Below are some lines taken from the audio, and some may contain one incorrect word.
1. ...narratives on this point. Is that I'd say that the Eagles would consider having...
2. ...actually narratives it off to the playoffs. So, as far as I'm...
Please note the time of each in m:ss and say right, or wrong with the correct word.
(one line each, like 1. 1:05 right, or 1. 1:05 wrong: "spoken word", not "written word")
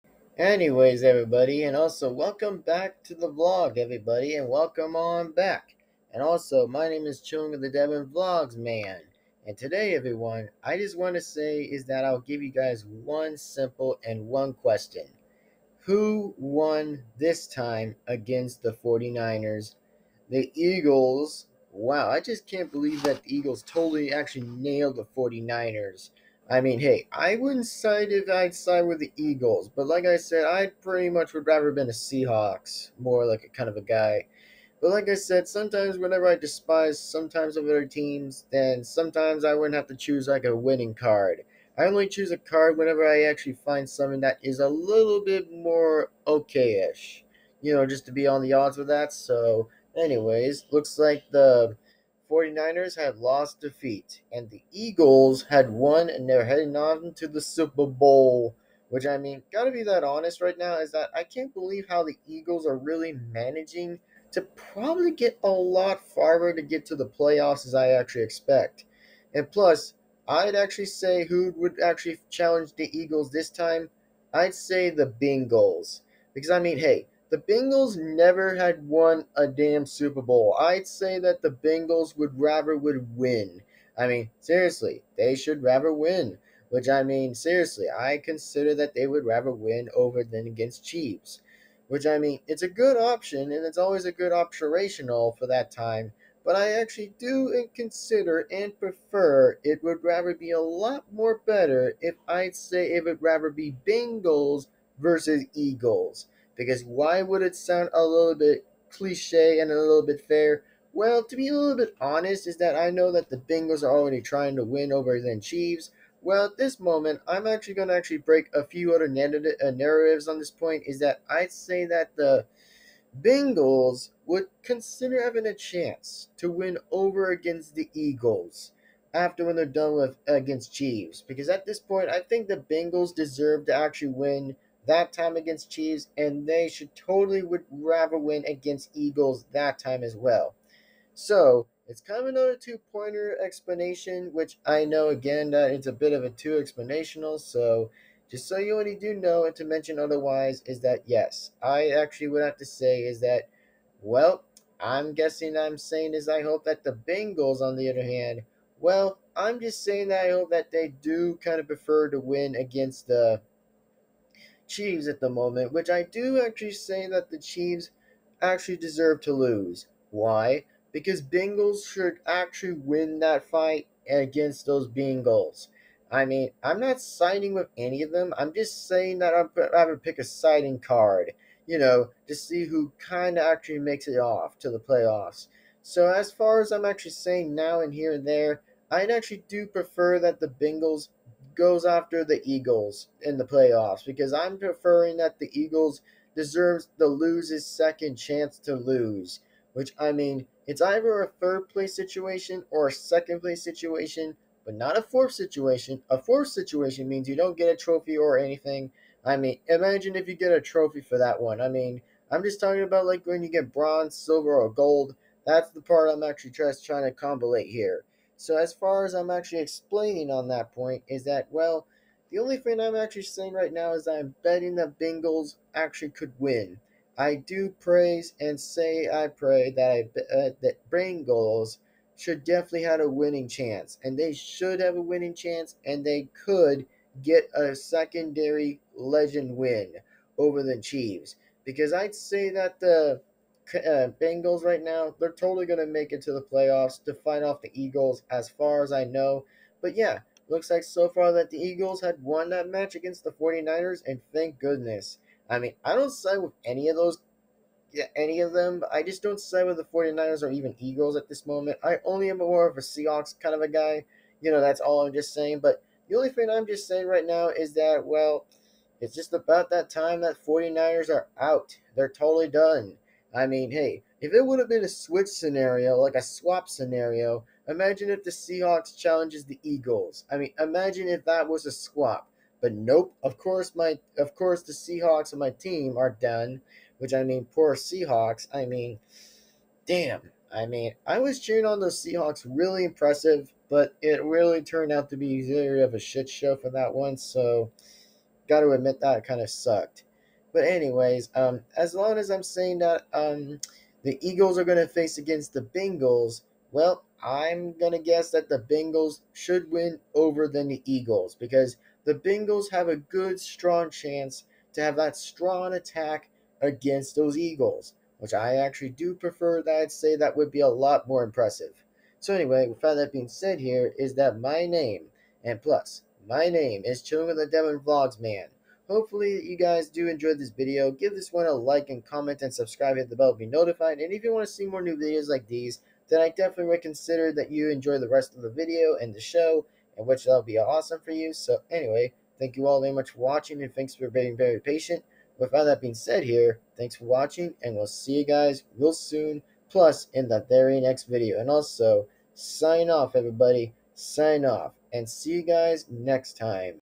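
1. 1:59 wrong: "Bengals", not "Eagles"
2. 3:03 wrong: "makes", not "narratives".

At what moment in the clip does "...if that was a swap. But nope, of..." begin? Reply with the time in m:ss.
4:41.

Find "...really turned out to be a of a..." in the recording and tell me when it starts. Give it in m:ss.
4:54.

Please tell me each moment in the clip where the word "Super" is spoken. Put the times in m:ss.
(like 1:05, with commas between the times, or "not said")
0:57, 1:19.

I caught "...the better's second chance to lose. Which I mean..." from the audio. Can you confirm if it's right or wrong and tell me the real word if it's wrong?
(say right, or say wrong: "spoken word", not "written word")
wrong: "loser", not "better".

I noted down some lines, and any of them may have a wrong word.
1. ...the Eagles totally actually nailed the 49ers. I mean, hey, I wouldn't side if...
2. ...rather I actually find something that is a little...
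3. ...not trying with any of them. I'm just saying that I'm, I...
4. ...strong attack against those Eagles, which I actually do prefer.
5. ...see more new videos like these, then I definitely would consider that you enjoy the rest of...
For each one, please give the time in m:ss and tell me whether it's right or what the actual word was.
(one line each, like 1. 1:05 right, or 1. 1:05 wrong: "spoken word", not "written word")
1. 0:23 right
2. 0:42 wrong: "whenever", not "rather"
3. 2:56 wrong: "siding", not "trying"
4. 5:15 right
5. 5:34 right.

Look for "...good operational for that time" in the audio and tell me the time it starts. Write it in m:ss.
1:34.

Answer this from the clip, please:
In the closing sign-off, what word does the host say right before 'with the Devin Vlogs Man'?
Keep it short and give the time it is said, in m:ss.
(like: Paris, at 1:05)
Chilling, at 5:27.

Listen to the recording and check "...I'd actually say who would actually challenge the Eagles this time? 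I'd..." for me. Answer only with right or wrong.
right.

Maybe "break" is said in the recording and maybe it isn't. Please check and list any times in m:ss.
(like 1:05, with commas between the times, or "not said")
1:58.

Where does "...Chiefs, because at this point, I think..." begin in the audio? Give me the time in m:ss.
2:10.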